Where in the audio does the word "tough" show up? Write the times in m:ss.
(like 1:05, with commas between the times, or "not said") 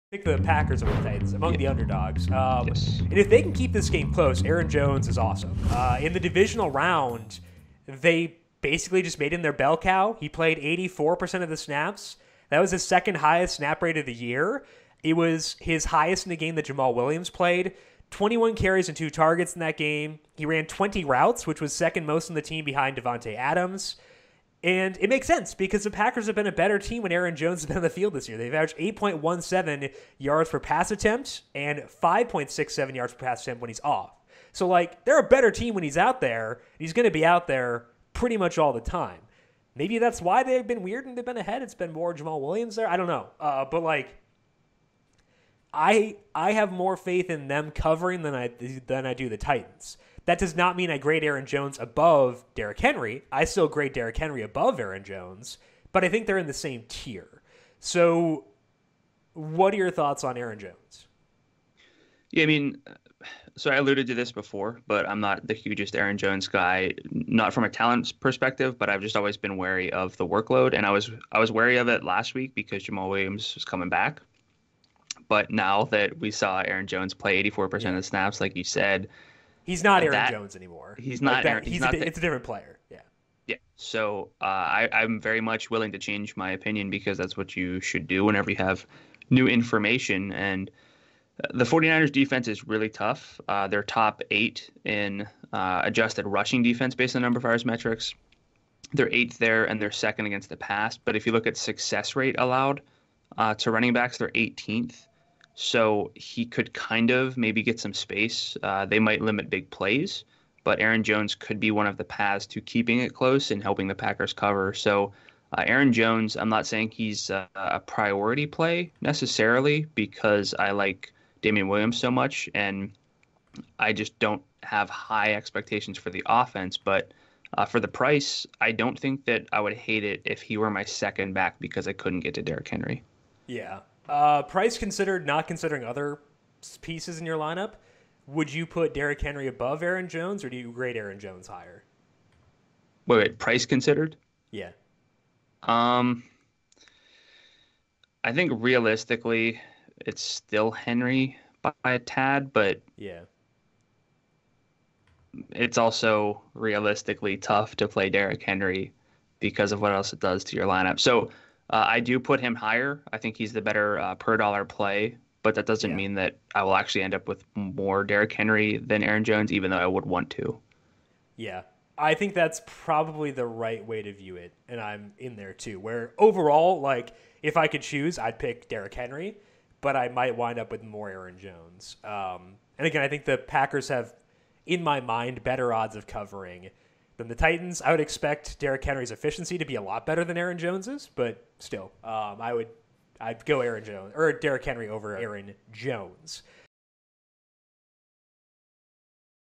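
1:32, 2:37.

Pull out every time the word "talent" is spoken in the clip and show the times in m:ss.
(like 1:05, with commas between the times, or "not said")
1:07.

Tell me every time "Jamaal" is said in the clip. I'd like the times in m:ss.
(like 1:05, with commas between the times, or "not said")
0:16, 0:42, 1:12.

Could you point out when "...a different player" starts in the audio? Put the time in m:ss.
1:22.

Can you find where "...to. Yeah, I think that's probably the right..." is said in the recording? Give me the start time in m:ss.
2:50.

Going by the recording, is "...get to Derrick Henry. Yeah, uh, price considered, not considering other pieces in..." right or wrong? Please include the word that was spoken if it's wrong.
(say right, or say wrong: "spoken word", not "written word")
right.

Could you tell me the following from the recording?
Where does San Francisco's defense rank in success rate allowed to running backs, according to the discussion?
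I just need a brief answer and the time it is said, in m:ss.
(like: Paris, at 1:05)
18th, at 1:44.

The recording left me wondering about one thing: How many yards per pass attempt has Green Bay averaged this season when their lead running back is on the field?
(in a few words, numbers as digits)
8.17.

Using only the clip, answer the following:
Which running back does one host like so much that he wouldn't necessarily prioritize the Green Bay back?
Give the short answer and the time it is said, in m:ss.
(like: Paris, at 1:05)
Damien Williams, at 2:01.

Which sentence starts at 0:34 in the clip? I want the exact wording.
So, like, they're a better team when he's out there.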